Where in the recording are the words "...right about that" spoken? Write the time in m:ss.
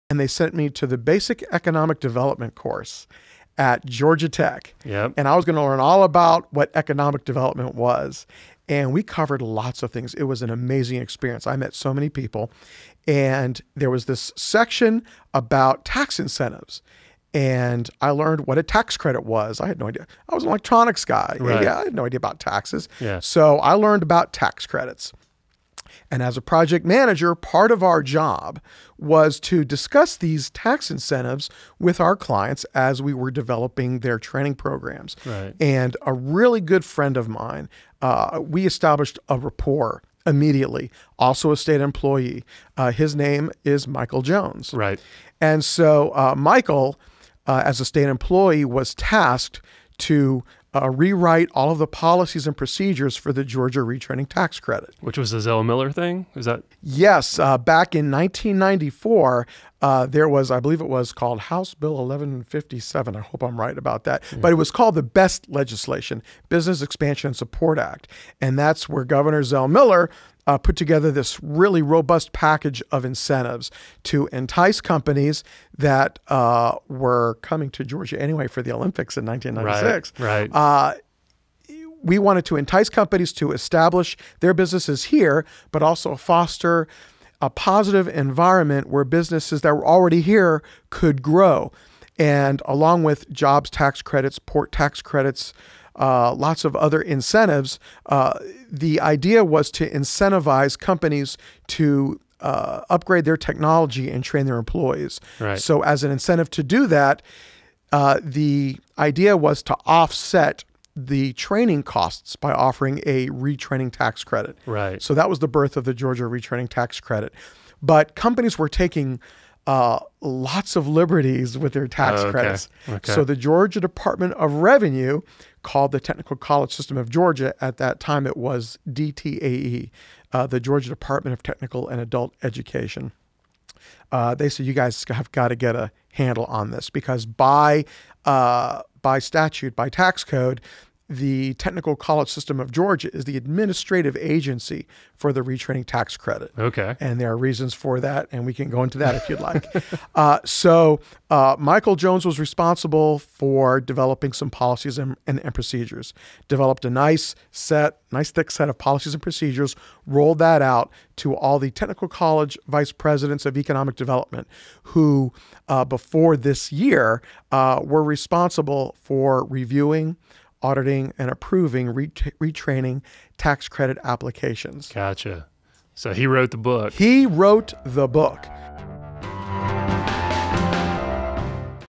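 1:03.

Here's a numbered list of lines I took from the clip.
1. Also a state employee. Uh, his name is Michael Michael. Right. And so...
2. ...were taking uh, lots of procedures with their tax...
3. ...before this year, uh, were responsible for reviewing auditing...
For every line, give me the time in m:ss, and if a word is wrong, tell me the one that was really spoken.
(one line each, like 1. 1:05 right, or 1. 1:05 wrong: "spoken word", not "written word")
1. 0:41 wrong: "Jones", not "Michael"
2. 1:58 wrong: "liberties", not "procedures"
3. 2:45 right.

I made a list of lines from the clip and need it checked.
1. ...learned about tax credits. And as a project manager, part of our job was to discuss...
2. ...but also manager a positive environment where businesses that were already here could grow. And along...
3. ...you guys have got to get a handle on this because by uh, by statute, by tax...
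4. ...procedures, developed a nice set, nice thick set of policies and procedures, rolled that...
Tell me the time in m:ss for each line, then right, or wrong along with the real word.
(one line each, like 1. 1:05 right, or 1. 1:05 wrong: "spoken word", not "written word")
1. 0:23 right
2. 1:25 wrong: "foster", not "manager"
3. 2:14 right
4. 2:35 right.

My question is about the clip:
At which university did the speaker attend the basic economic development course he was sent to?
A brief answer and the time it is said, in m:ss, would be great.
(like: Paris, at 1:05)
Georgia Tech, at 0:03.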